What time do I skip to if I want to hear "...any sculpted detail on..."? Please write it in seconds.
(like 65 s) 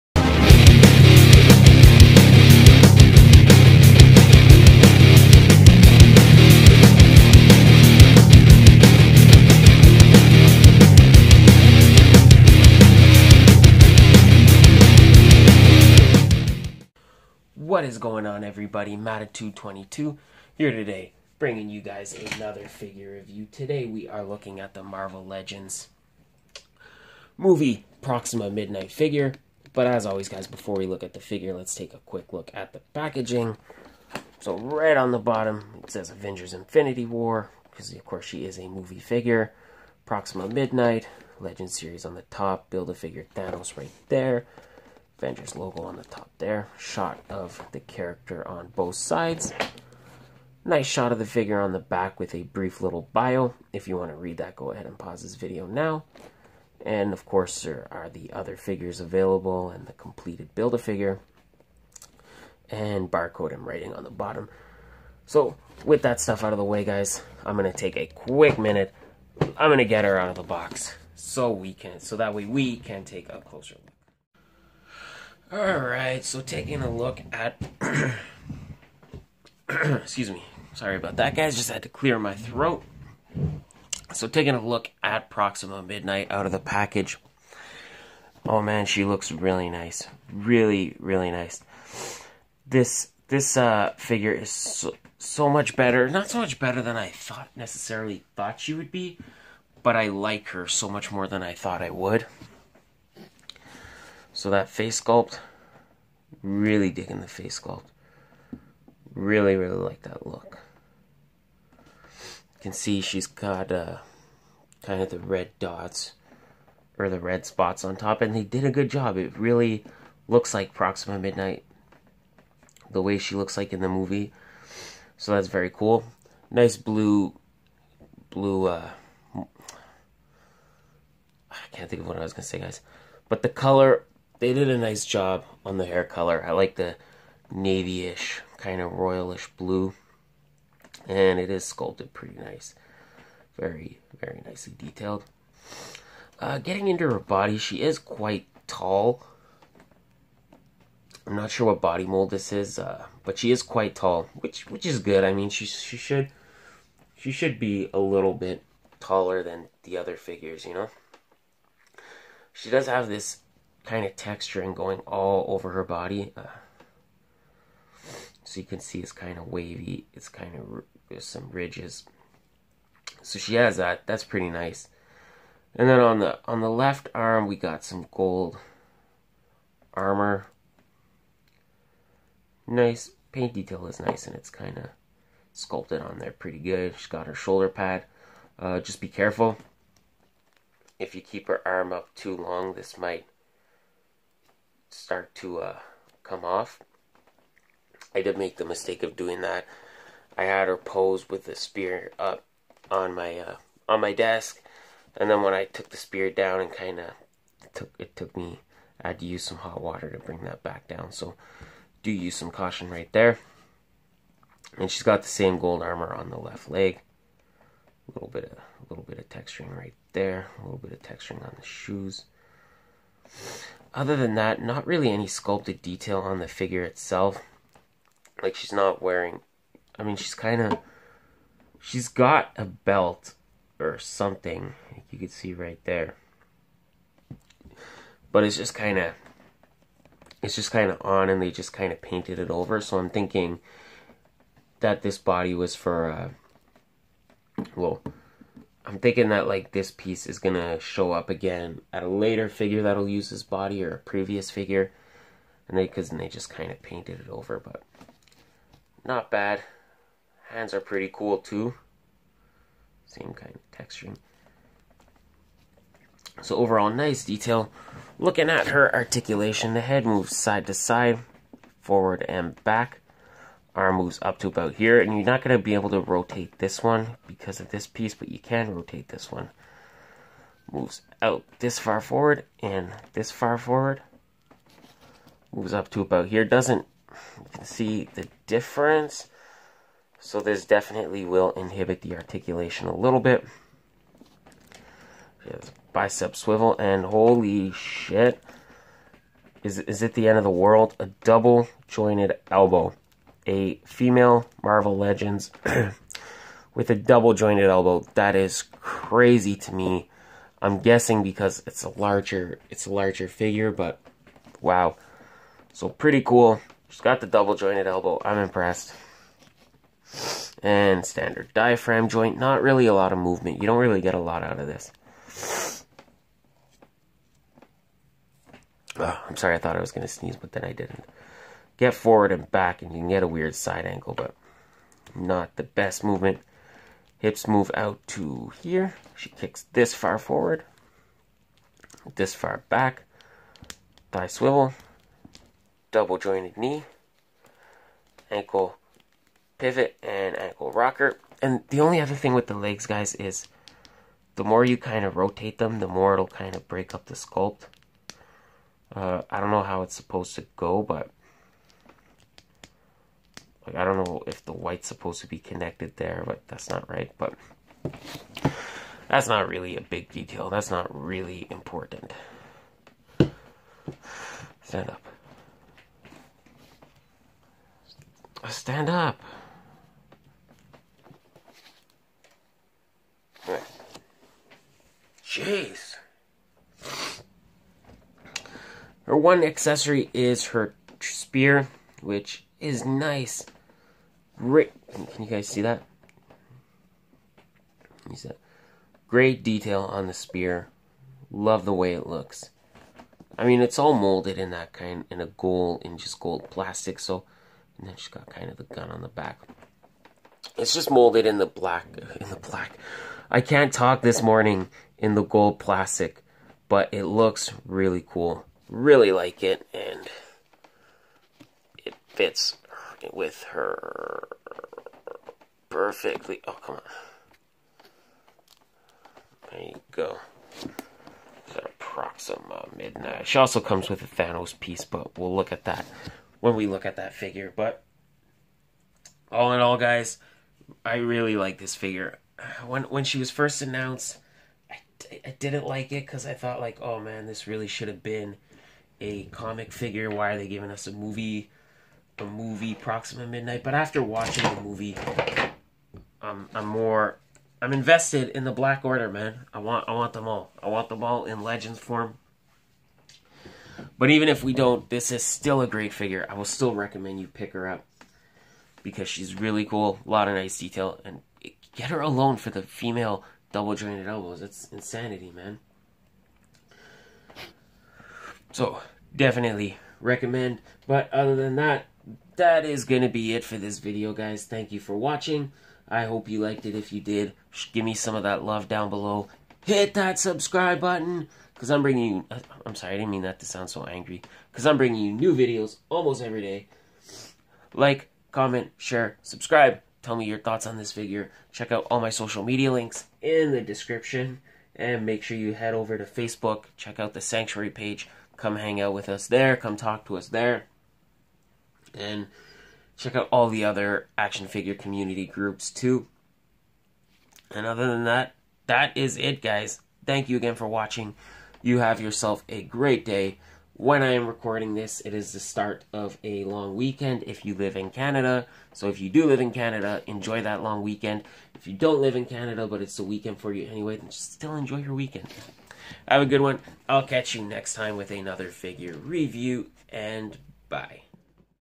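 225 s.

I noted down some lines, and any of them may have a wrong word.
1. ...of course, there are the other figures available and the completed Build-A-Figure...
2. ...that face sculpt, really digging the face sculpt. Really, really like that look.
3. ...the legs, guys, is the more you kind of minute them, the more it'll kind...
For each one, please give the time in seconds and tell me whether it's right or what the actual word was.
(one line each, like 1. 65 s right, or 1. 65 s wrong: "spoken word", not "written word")
1. 57 s right
2. 104 s right
3. 352 s wrong: "rotate", not "minute".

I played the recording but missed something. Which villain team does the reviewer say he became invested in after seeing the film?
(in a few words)
The Black Order.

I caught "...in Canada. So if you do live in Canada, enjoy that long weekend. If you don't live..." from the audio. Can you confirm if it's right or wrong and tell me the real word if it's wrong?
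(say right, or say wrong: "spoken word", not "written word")
right.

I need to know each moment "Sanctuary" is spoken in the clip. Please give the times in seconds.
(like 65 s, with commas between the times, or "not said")
507 s.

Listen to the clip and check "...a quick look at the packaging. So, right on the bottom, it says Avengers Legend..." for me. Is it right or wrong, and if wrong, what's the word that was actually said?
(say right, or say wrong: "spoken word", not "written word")
wrong: "Infinity", not "Legend".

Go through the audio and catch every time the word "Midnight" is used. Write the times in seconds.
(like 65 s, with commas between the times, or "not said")
28 s, 40 s, 85 s, 121 s, 432 s, 453 s.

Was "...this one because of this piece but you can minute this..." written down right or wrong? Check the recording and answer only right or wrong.
wrong.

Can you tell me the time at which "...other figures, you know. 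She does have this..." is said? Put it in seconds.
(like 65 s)
159 s.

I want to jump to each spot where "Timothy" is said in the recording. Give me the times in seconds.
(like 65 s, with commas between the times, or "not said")
not said.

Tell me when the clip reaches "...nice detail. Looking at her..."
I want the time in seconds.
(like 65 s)
266 s.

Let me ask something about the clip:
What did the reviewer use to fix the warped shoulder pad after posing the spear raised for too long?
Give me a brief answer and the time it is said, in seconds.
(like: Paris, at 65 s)
Hot water, at 209 s.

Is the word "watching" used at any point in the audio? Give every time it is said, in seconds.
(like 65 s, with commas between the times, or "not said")
454 s, 484 s, 520 s.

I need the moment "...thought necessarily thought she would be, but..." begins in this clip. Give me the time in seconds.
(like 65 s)
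97 s.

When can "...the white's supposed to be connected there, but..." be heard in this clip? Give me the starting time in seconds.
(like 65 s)
364 s.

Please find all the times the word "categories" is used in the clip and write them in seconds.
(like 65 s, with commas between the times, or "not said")
not said.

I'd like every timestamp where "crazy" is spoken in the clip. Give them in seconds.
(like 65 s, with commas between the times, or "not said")
308 s.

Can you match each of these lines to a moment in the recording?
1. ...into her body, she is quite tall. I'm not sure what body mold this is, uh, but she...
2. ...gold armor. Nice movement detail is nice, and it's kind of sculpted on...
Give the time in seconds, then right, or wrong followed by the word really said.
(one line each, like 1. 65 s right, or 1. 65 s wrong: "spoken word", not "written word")
1. 146 s right
2. 178 s wrong: "paint", not "movement".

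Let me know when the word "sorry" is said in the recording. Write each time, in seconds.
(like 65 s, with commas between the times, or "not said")
80 s, 329 s, 492 s.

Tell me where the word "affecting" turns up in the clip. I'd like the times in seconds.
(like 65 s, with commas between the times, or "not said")
not said.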